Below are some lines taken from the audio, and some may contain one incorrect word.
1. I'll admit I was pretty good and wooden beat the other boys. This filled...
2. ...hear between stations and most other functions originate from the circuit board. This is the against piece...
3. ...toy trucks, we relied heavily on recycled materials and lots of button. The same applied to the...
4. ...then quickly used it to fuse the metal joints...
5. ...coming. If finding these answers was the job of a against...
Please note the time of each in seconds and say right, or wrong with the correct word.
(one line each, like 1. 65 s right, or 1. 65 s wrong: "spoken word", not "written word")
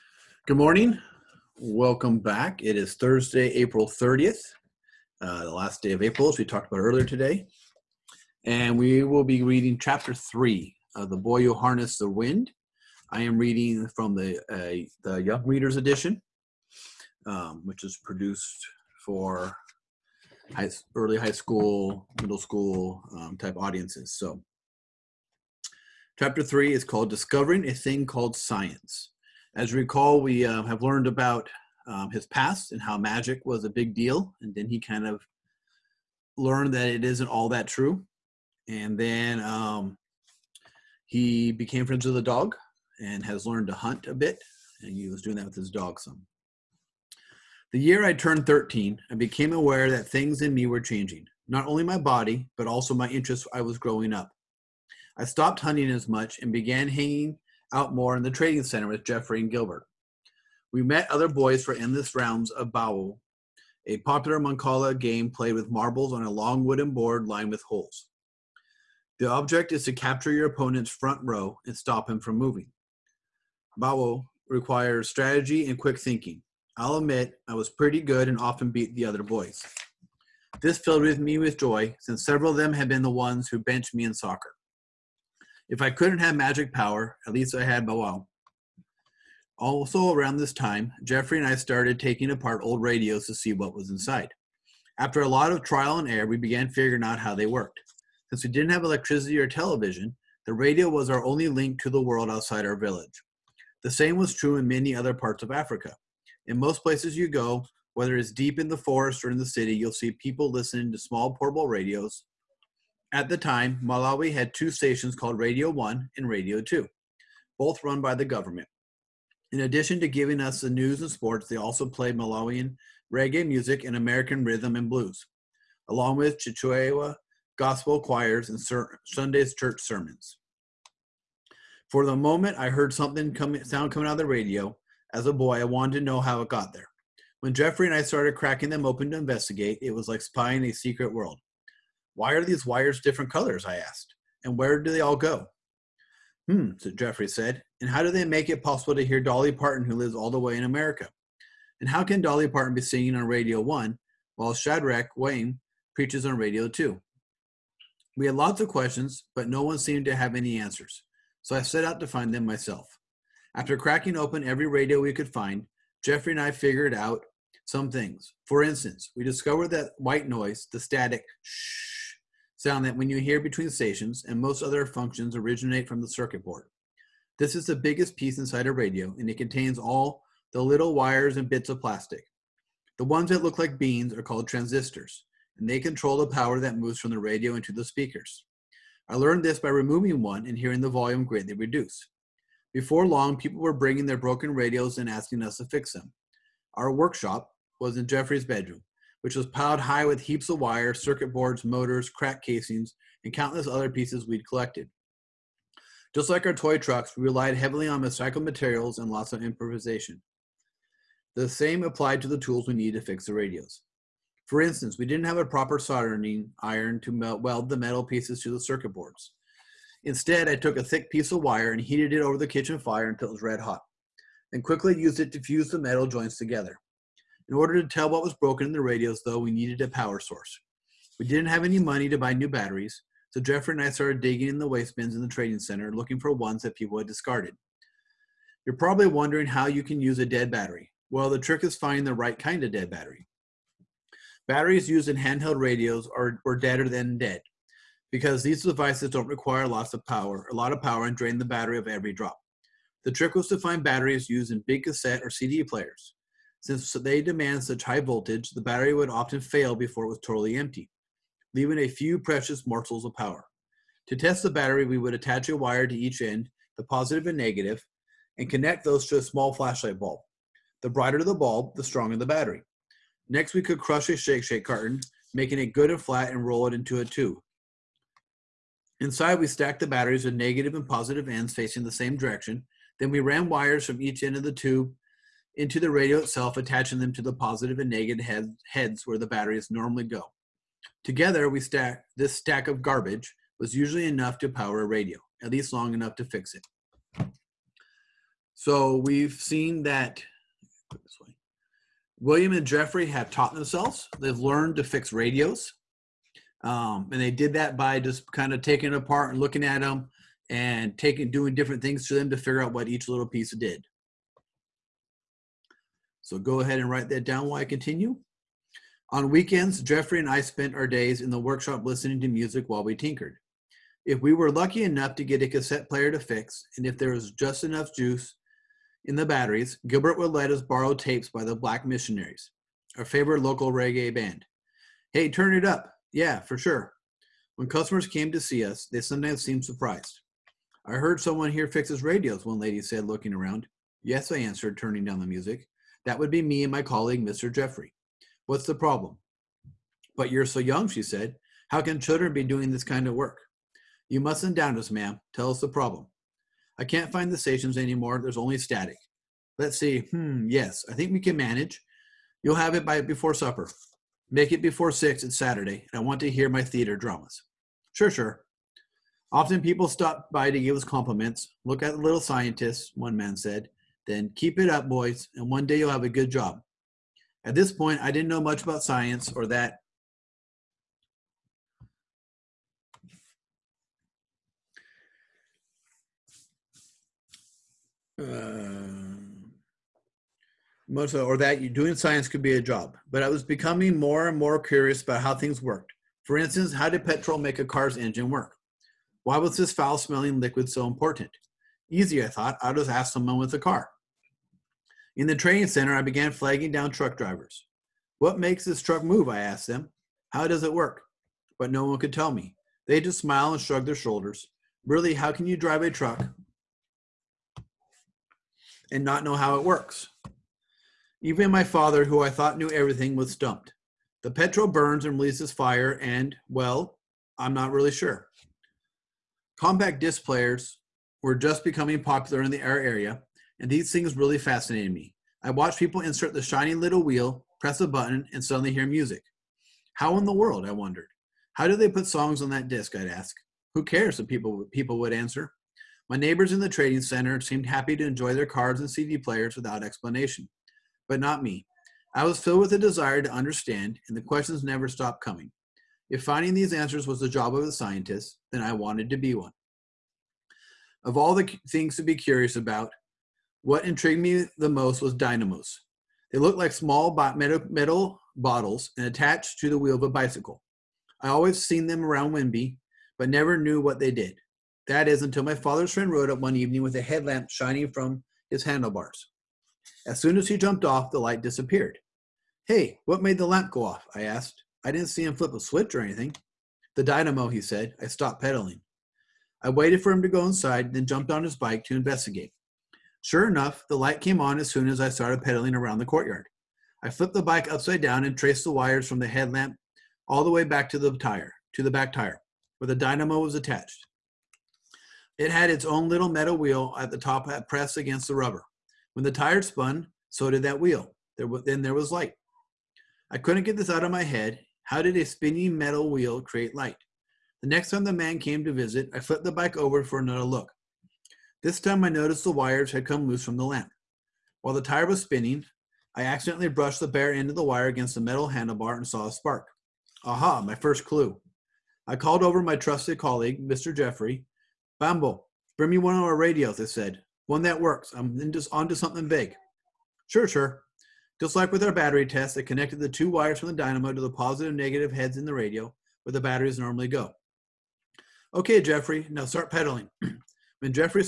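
1. 76 s wrong: "often", not "wooden"
2. 173 s wrong: "biggest", not "against"
3. 206 s wrong: "improvisation", not "button"
4. 224 s right
5. 455 s wrong: "scientist", not "against".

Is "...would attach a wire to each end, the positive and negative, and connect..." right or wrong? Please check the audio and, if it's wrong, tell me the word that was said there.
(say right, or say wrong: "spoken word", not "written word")
right.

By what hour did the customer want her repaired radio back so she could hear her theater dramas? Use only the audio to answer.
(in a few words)
6.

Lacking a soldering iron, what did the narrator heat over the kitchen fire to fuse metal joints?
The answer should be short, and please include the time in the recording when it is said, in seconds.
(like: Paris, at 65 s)
a thick piece of wire, at 220 s.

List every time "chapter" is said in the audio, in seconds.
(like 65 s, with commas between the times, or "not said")
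9 s, 26 s.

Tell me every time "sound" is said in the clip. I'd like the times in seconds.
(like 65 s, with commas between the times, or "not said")
133 s, 172 s.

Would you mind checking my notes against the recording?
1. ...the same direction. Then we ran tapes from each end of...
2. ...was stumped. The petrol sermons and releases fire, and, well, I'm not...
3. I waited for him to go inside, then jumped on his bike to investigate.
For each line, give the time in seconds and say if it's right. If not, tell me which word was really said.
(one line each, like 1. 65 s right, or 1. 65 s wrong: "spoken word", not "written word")
1. 281 s wrong: "wires", not "tapes"
2. 423 s wrong: "burns", not "sermons"
3. 489 s right.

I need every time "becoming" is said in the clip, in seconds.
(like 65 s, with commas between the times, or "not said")
393 s, 431 s.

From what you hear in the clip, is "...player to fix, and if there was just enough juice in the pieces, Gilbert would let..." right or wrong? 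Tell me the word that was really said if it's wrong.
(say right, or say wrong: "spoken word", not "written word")
wrong: "batteries", not "pieces".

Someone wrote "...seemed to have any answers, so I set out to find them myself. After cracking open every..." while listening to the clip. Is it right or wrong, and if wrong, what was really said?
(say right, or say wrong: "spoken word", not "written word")
right.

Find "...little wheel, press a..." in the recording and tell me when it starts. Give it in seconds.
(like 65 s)
436 s.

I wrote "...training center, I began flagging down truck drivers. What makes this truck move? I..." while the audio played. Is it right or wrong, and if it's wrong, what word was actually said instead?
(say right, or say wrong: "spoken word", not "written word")
right.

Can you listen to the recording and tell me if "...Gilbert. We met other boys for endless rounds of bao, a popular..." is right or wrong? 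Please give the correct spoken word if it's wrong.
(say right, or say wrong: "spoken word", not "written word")
right.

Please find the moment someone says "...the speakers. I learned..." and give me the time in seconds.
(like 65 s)
187 s.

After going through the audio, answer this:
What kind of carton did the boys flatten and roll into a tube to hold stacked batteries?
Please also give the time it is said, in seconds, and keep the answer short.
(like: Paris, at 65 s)
Shake Shake carton, at 274 s.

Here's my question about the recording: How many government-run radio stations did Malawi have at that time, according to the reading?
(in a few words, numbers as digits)
2.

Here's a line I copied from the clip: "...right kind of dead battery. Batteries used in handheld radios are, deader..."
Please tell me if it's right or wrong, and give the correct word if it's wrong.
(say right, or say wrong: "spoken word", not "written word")
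right.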